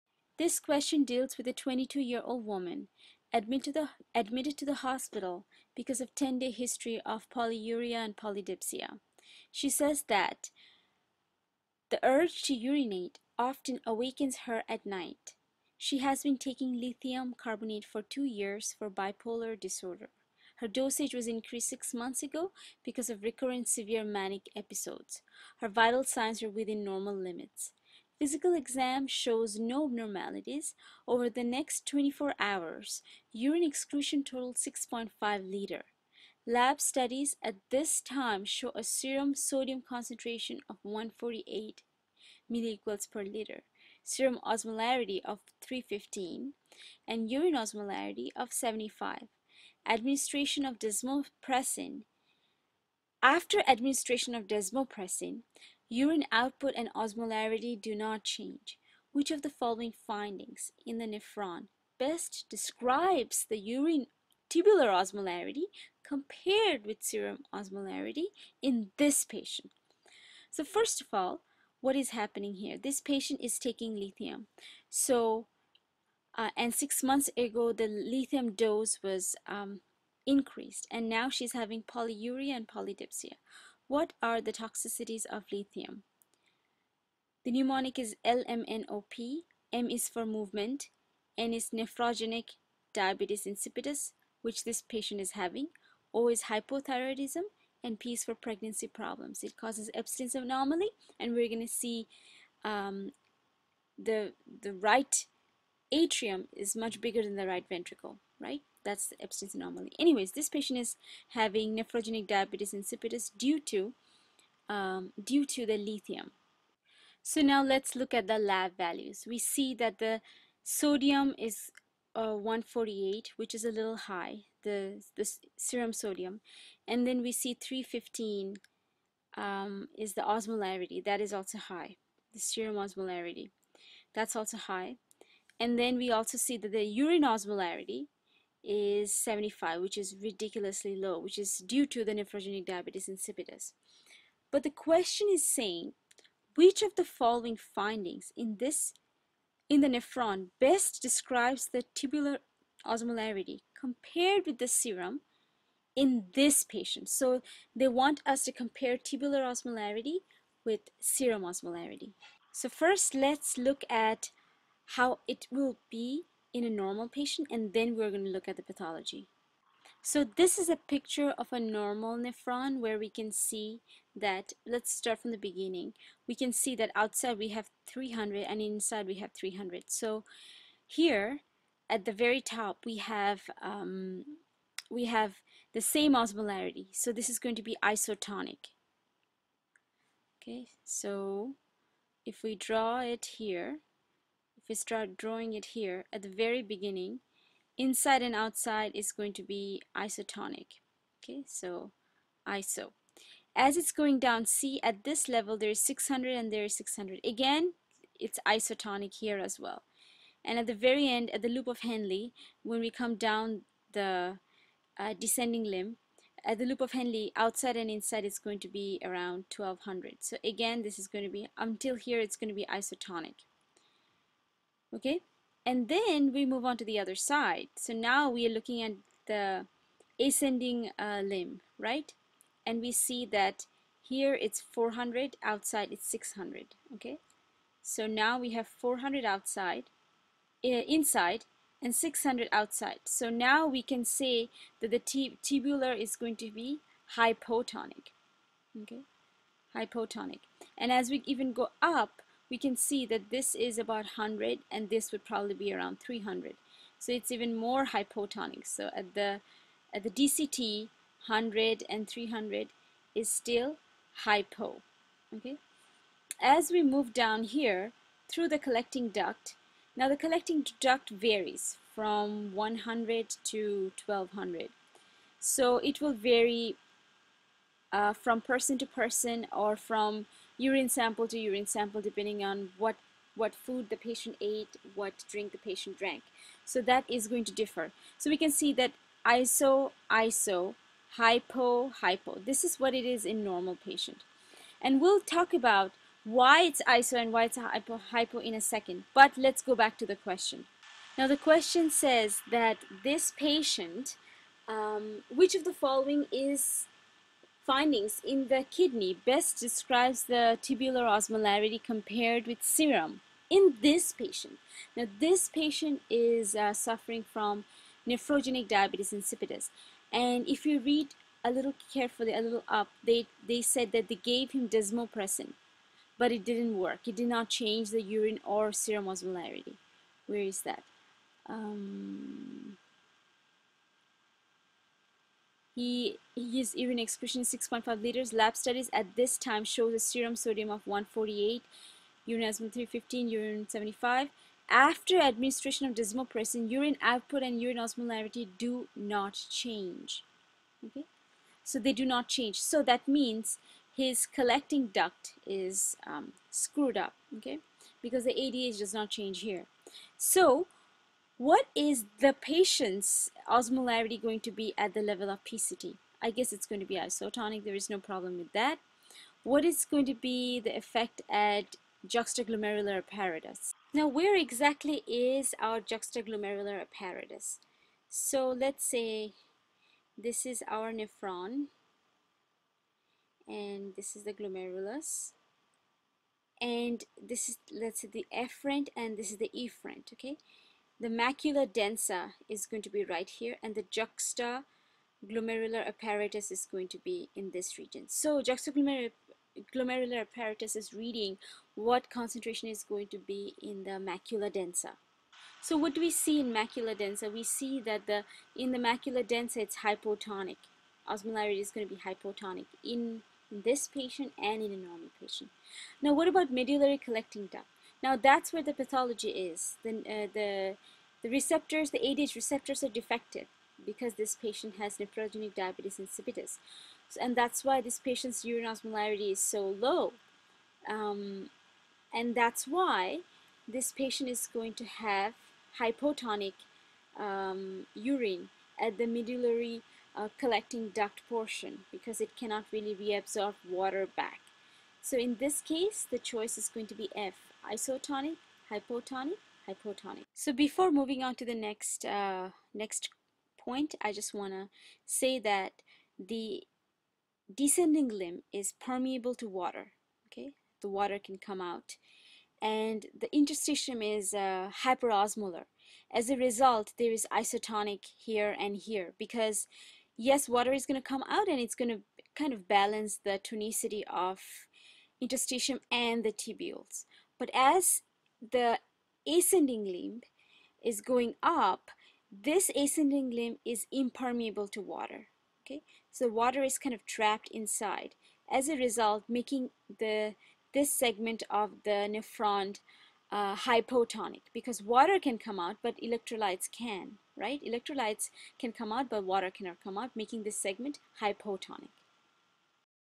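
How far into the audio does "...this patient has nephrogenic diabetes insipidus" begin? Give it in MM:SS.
07:04.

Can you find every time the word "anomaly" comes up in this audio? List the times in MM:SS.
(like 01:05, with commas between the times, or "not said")
01:40, 01:49.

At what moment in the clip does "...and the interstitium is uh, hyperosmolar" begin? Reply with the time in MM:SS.
07:42.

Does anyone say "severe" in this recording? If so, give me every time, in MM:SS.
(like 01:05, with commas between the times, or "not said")
00:23.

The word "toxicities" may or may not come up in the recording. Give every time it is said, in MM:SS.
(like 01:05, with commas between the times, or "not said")
01:24.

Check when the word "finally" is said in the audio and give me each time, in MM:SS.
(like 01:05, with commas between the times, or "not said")
not said.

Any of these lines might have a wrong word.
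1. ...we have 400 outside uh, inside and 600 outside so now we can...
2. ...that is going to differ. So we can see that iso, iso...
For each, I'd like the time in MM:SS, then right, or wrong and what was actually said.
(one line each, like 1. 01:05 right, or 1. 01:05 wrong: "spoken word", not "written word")
1. 03:58 right
2. 04:46 right.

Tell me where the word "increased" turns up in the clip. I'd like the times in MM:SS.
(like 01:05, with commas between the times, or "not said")
00:21, 01:20.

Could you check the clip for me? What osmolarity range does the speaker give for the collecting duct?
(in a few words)
100 to 1200.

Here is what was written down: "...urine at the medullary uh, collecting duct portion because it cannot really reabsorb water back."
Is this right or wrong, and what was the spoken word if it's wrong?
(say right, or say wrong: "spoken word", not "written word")
right.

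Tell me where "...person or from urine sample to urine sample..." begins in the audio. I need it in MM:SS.
04:38.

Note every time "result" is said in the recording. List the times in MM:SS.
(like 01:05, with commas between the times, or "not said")
07:46, 08:08.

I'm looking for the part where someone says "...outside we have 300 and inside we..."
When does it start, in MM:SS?
02:56.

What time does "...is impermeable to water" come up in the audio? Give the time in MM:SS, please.
08:03.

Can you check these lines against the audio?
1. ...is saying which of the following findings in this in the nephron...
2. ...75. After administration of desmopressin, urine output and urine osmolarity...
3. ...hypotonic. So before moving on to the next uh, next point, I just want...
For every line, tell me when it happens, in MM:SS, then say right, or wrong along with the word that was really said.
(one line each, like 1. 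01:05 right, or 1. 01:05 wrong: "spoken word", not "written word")
1. 02:25 right
2. 05:43 right
3. 07:29 right.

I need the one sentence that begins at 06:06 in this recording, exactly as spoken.
I guess it's going to be isotonic.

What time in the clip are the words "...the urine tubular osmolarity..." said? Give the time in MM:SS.
01:03.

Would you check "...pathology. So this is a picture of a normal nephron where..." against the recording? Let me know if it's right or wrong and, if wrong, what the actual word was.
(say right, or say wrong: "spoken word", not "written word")
right.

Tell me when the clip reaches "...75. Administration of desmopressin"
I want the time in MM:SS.
00:48.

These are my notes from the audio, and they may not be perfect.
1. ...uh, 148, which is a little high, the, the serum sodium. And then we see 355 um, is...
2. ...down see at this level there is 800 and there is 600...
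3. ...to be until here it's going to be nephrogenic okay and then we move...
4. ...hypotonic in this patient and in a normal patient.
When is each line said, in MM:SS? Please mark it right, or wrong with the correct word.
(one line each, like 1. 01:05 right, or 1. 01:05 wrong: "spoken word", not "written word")
1. 02:02 wrong: "315", not "355"
2. 03:24 wrong: "600", not "800"
3. 03:41 wrong: "isotonic", not "nephrogenic"
4. 06:52 right.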